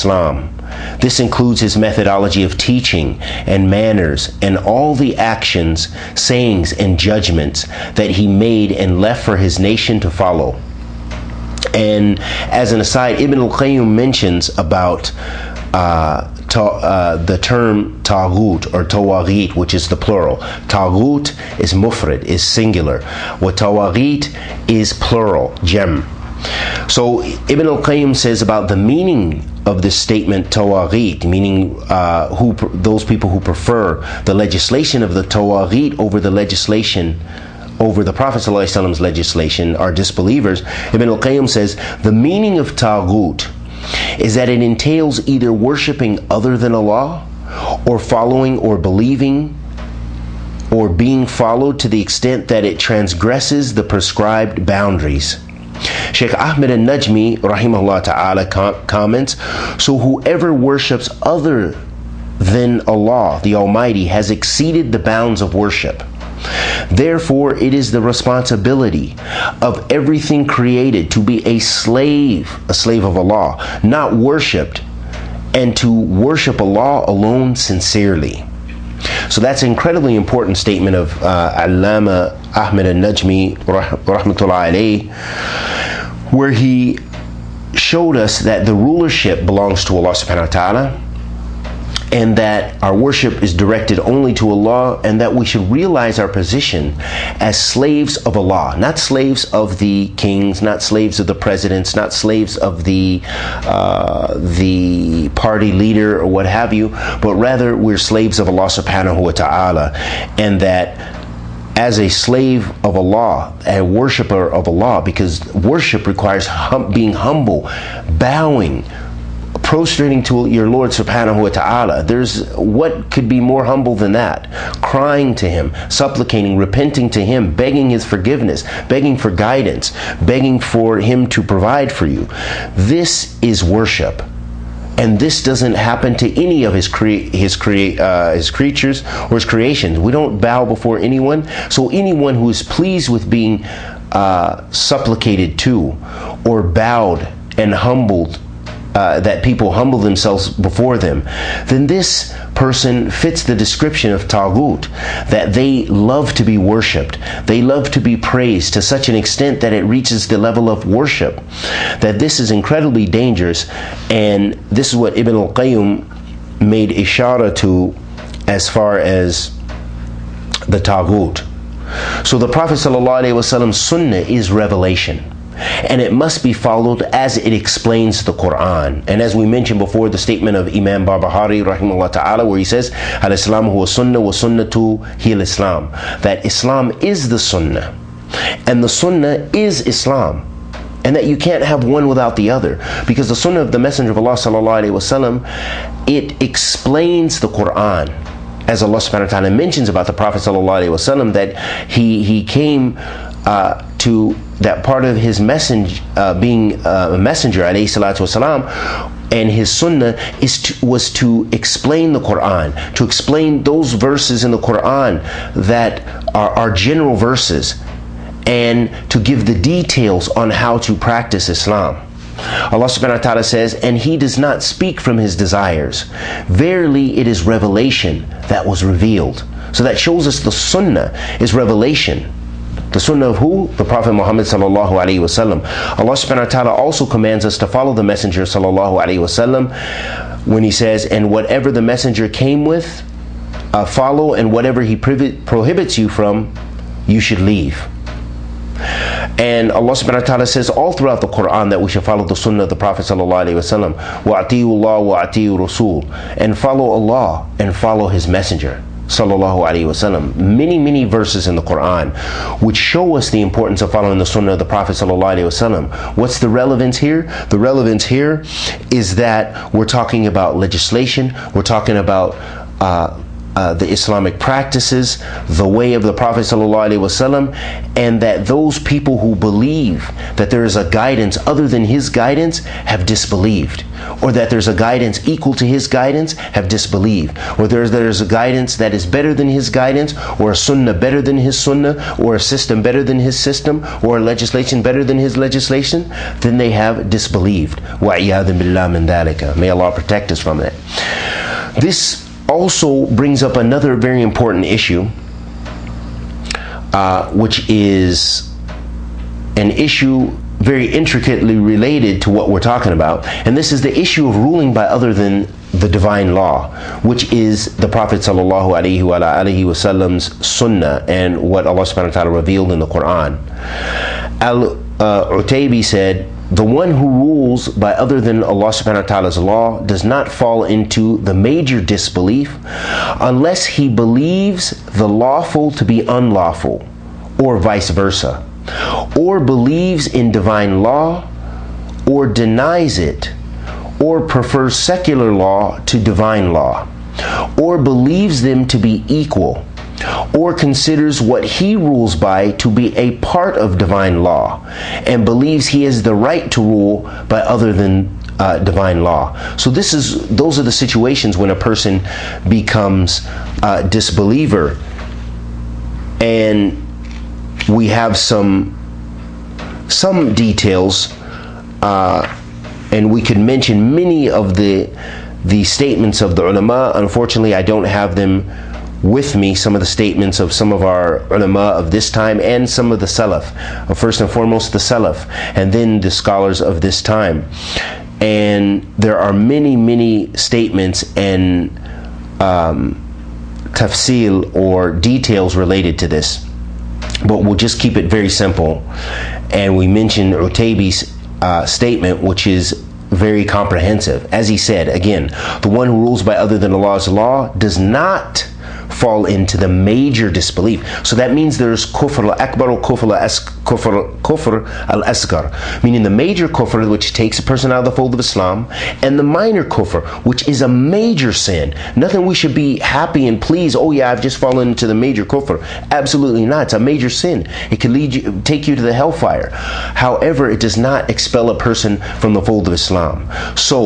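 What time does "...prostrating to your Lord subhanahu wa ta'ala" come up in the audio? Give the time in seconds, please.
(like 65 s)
119 s.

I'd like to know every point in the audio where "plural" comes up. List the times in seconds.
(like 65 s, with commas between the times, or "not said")
19 s, 24 s.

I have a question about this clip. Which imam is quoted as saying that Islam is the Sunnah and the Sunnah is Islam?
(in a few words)
Imam Barbahari.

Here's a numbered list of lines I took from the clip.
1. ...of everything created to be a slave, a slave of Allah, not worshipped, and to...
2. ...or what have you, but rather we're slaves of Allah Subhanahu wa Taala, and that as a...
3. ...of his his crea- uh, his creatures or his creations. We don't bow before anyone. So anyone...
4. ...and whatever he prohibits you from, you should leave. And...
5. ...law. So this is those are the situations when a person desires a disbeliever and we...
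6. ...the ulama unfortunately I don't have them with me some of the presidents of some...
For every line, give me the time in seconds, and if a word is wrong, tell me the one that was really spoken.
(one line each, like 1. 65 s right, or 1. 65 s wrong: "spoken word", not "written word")
1. 69 s right
2. 106 s right
3. 136 s right
4. 244 s right
5. 359 s wrong: "becomes", not "desires"
6. 376 s wrong: "statements", not "presidents".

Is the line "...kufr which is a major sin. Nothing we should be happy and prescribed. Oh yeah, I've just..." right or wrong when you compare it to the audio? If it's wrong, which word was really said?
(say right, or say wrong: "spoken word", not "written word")
wrong: "pleased", not "prescribed".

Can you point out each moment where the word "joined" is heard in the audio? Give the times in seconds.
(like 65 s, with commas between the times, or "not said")
not said.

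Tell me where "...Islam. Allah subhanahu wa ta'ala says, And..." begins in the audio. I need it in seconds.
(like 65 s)
221 s.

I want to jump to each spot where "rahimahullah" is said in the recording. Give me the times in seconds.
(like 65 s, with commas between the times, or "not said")
57 s, 181 s.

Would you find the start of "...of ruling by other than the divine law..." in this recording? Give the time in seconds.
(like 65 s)
314 s.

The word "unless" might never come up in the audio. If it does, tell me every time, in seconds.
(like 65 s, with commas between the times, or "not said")
333 s.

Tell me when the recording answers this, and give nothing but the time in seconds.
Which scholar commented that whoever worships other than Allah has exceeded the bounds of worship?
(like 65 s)
56 s.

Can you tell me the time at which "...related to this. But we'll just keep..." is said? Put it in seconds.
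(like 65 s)
395 s.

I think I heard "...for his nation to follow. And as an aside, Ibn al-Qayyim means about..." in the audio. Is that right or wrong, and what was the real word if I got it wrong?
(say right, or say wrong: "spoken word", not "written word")
wrong: "mentions", not "means".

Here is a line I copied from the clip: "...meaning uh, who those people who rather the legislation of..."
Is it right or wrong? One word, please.
wrong.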